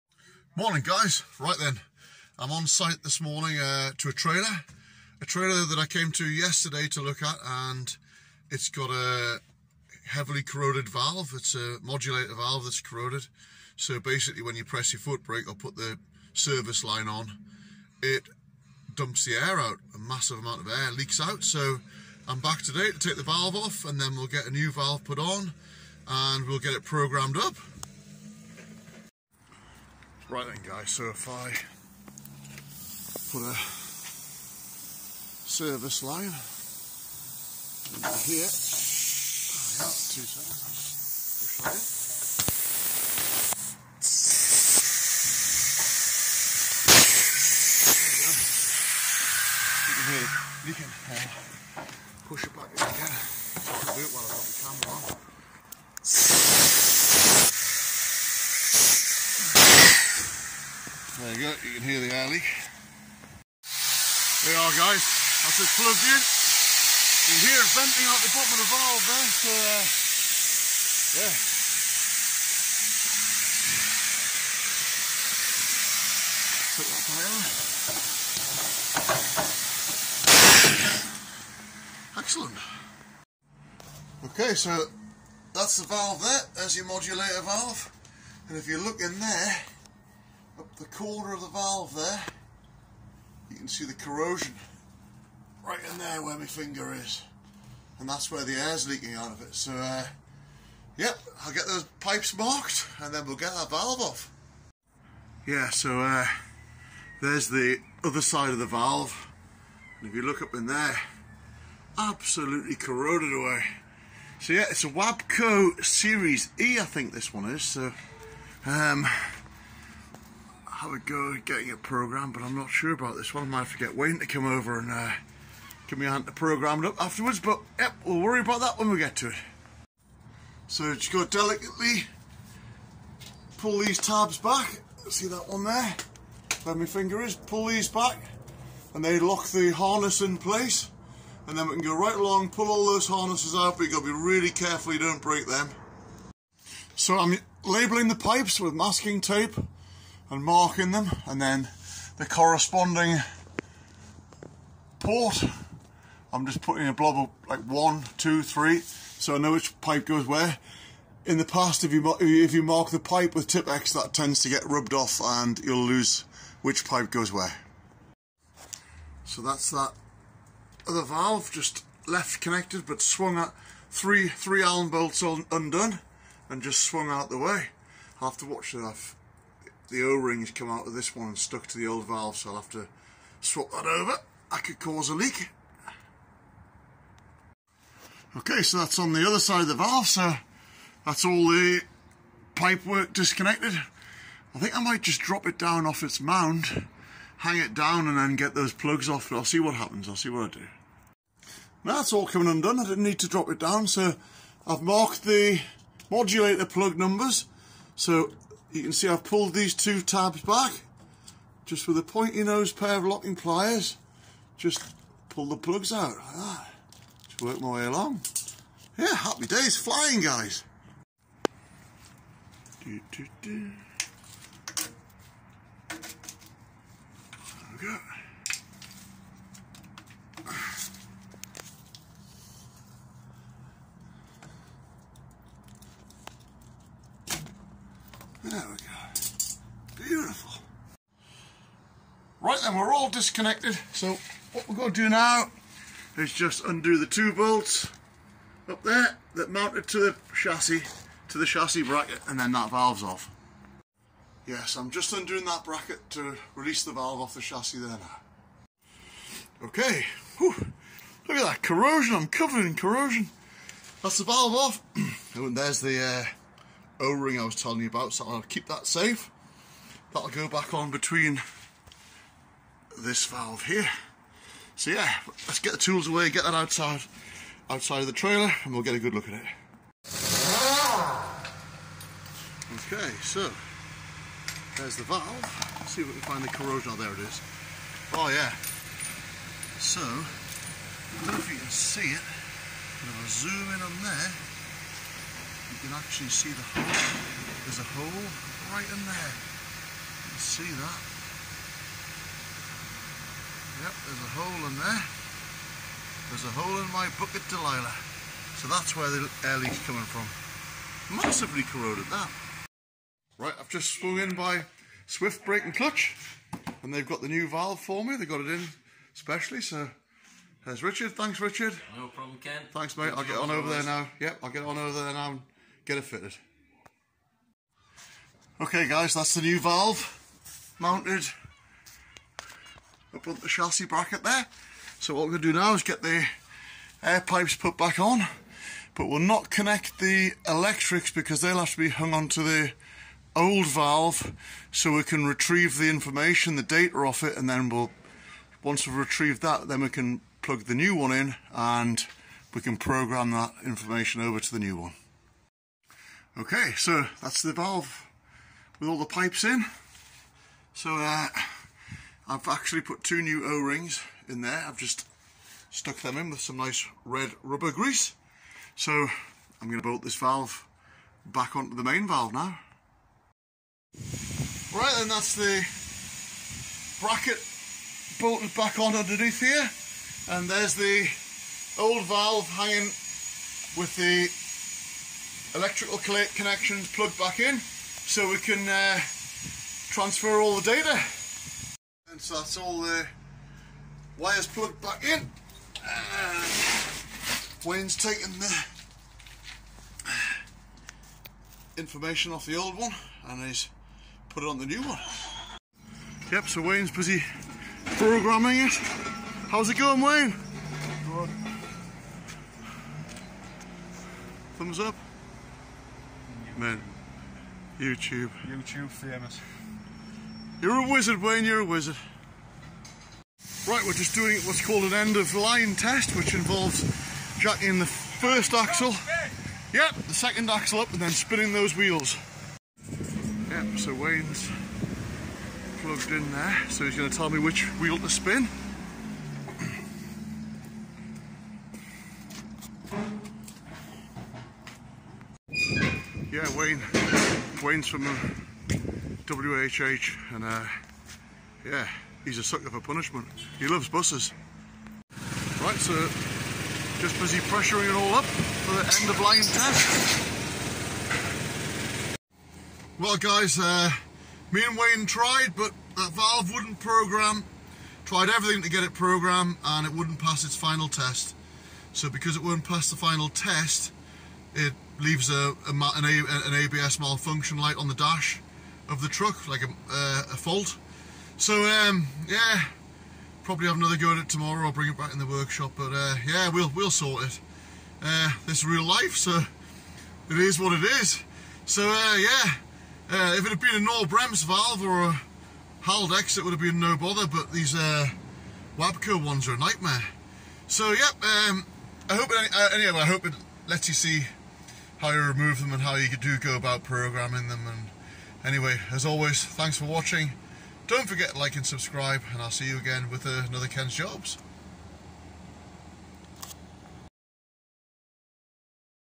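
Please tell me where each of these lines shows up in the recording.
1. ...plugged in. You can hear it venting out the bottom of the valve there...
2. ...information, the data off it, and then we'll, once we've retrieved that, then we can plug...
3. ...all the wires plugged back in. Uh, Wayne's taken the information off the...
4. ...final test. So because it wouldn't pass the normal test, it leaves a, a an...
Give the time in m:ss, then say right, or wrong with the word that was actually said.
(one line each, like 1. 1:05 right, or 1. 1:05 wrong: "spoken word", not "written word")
1. 1:05 right
2. 5:45 right
3. 6:32 right
4. 7:50 wrong: "final", not "normal".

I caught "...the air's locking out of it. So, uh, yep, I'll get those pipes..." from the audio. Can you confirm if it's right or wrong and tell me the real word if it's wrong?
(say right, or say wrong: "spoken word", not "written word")
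wrong: "leaking", not "locking".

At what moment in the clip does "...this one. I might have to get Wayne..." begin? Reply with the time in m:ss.
2:03.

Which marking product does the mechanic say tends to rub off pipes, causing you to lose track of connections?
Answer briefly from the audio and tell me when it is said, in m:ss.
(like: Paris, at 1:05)
Tipp-Ex, at 2:43.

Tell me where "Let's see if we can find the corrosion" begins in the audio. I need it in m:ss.
4:45.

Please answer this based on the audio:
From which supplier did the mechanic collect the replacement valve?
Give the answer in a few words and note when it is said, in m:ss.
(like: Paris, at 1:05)
Swift Brake and Clutch, at 5:15.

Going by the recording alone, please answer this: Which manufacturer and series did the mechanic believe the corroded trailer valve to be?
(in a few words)
Wabco Series E.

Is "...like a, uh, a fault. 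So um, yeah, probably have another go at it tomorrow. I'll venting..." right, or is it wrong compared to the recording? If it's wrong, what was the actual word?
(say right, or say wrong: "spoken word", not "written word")
wrong: "bring", not "venting".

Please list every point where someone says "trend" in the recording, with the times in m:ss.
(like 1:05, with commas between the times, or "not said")
not said.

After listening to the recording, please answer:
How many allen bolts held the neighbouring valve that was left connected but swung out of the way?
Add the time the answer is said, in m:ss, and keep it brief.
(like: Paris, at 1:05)
3, at 2:54.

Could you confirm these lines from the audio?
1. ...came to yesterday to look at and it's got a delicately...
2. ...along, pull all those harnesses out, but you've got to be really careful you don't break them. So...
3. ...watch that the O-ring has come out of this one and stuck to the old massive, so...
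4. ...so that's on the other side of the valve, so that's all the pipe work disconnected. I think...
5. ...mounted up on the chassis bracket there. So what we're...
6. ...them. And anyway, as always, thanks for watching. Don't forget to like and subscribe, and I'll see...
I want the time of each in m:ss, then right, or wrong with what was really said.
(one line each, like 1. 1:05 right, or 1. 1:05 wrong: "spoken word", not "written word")
1. 0:05 wrong: "heavily", not "delicately"
2. 2:22 right
3. 2:58 wrong: "valve", not "massive"
4. 3:08 right
5. 5:30 right
6. 8:27 right.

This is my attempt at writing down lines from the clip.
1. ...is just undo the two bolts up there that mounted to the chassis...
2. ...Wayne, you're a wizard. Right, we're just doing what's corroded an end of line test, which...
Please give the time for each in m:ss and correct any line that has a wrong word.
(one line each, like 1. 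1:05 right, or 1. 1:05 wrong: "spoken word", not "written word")
1. 4:06 right
2. 7:01 wrong: "called", not "corroded".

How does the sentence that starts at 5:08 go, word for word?
So that's where the air leak's coming from.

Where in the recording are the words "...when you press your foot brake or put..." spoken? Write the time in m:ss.
0:14.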